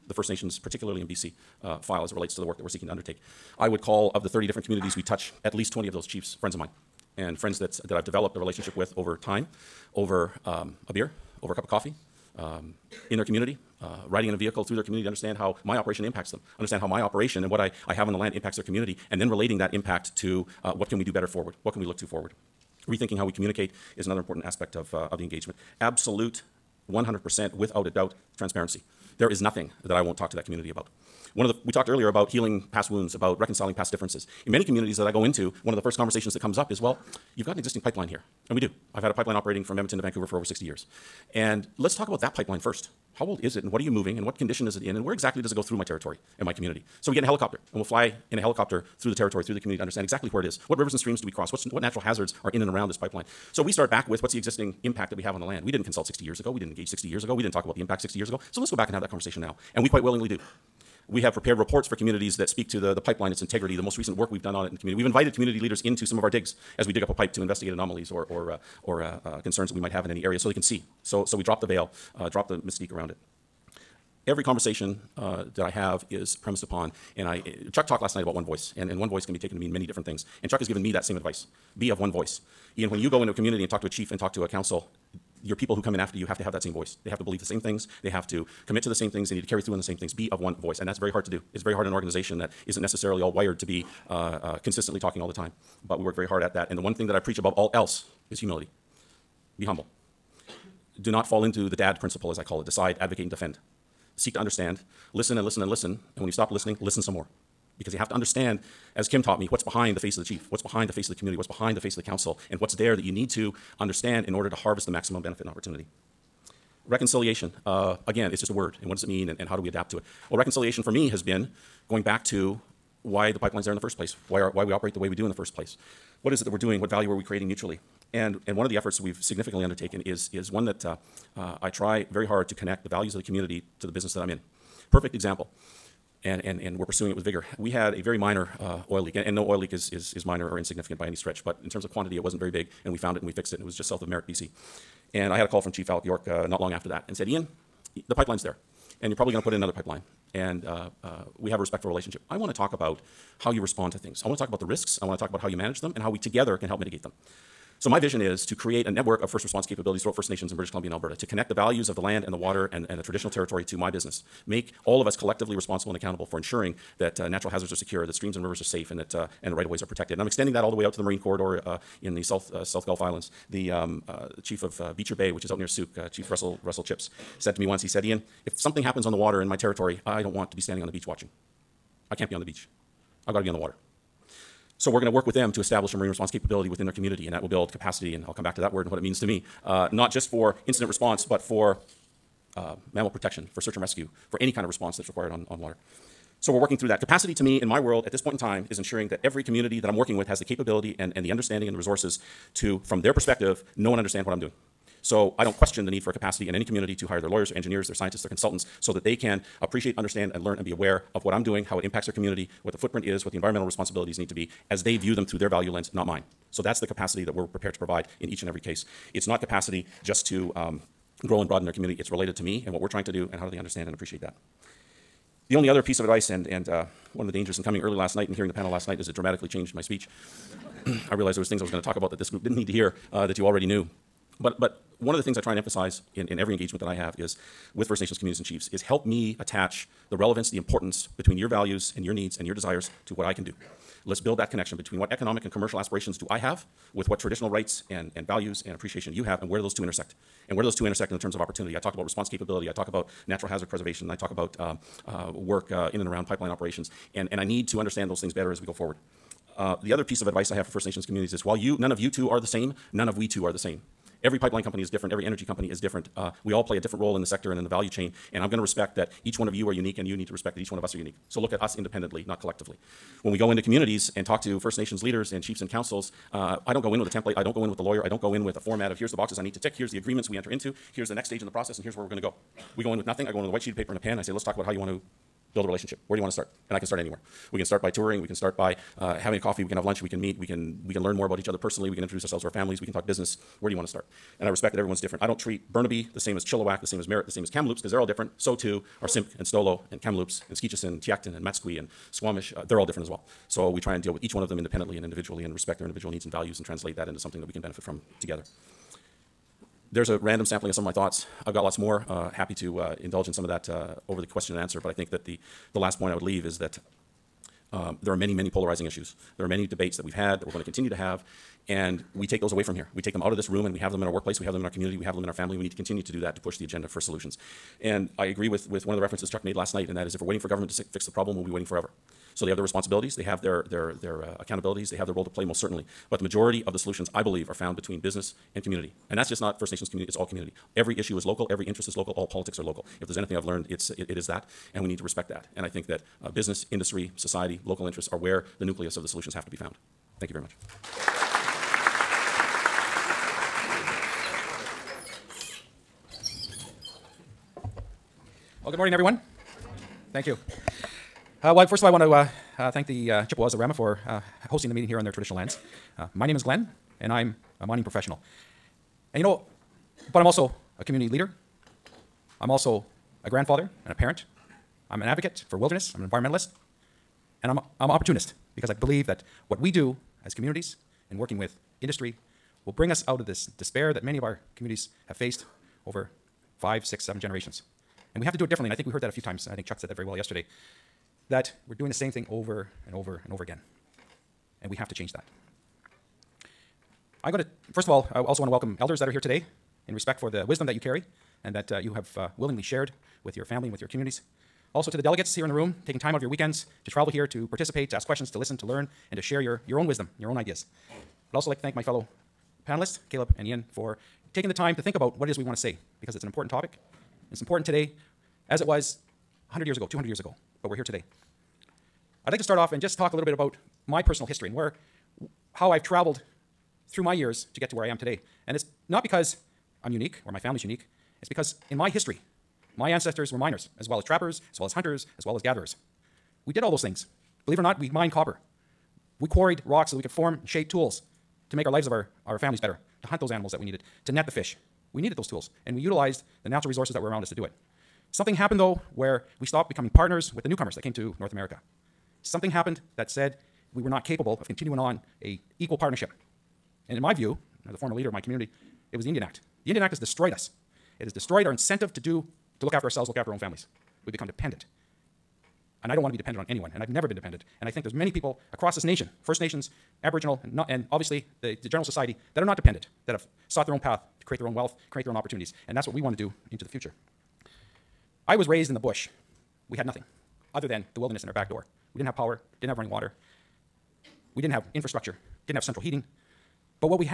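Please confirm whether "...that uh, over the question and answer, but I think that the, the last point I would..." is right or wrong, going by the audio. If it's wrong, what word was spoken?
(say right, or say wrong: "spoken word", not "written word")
right.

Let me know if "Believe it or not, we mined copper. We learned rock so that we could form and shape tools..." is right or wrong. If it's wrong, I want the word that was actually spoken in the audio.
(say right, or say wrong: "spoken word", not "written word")
wrong: "quarried", not "learned".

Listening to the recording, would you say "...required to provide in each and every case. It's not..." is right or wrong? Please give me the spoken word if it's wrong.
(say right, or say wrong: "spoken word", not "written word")
wrong: "prepared", not "required".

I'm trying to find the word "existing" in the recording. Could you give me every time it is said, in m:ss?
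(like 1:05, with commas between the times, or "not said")
0:37, 0:54.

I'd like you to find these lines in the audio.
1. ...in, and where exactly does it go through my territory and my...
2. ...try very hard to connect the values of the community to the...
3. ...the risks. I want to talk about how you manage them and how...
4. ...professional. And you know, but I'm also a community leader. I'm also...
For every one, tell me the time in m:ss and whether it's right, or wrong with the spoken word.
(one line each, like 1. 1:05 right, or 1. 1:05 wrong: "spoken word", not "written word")
1. 0:44 right
2. 2:11 right
3. 2:34 right
4. 6:07 right.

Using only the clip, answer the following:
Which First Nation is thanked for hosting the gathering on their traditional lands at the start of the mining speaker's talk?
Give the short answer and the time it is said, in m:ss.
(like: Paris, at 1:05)
Chippewas of Rama, at 6:03.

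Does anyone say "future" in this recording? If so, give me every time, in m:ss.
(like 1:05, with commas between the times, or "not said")
7:56.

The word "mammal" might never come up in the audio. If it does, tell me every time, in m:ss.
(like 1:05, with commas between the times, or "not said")
3:12.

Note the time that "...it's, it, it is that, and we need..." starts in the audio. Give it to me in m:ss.
5:43.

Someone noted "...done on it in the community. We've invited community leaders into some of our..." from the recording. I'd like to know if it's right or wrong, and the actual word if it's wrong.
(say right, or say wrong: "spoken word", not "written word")
right.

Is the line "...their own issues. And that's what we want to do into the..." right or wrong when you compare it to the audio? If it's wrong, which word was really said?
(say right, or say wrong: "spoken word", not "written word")
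wrong: "opportunities", not "issues".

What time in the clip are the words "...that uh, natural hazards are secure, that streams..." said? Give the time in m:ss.
2:46.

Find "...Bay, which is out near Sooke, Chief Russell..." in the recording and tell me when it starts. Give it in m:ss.
2:55.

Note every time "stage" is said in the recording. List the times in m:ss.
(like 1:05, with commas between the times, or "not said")
4:41.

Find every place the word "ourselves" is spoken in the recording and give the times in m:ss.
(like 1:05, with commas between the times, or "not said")
4:52, 7:42.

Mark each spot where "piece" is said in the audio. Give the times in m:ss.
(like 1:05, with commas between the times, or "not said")
3:45, 4:20.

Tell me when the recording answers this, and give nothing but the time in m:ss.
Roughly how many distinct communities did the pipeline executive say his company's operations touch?
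0:04.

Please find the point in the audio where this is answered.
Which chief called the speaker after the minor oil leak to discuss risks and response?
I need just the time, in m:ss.
2:25.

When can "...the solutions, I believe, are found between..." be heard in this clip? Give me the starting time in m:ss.
5:36.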